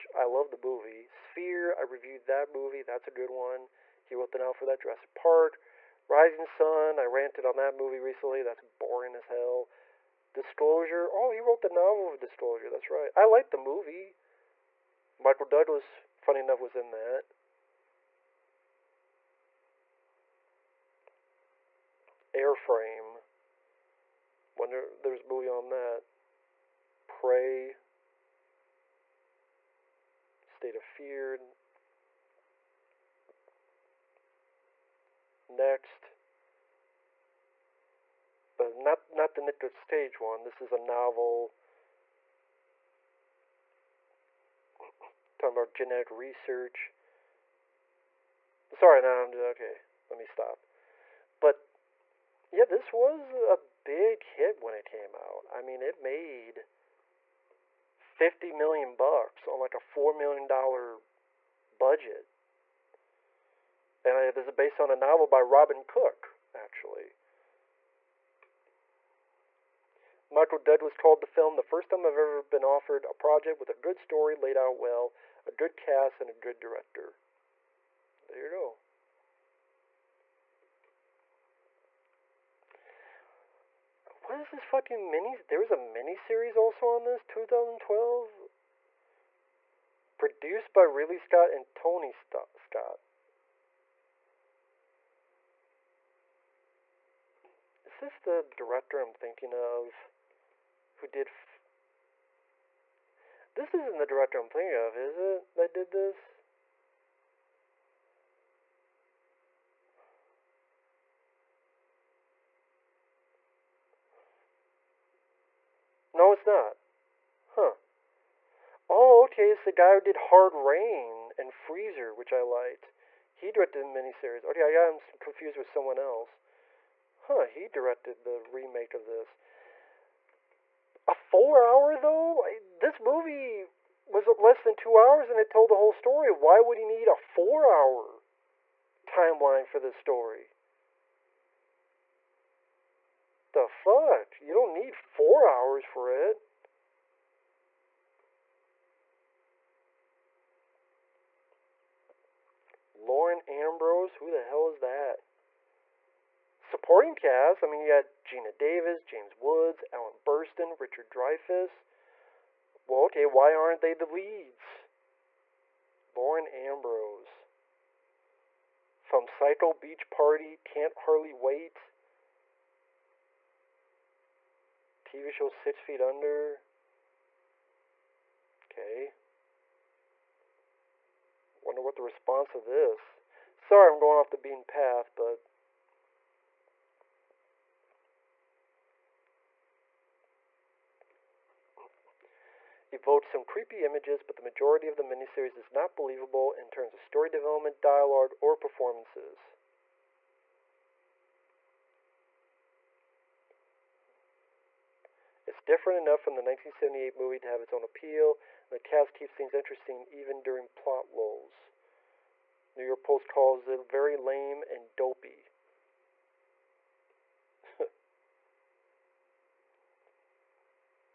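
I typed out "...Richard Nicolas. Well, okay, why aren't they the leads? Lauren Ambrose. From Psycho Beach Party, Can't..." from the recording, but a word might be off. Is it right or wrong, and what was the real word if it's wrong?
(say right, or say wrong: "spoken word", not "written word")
wrong: "Dreyfuss", not "Nicolas".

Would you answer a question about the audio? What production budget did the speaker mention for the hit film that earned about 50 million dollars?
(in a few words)
$4 million.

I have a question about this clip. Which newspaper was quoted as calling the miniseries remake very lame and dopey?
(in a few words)
New York Post.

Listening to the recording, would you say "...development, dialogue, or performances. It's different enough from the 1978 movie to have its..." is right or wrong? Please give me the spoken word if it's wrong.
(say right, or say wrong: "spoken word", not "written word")
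right.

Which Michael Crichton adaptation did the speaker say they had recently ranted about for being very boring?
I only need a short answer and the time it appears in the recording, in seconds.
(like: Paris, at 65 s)
Rising Sun, at 6 s.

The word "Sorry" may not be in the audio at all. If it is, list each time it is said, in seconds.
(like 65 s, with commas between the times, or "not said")
48 s, 183 s.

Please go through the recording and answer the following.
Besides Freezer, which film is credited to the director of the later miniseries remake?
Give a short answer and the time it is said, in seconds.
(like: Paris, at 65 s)
Hard Rain, at 120 s.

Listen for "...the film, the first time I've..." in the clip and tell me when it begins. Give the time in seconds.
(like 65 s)
70 s.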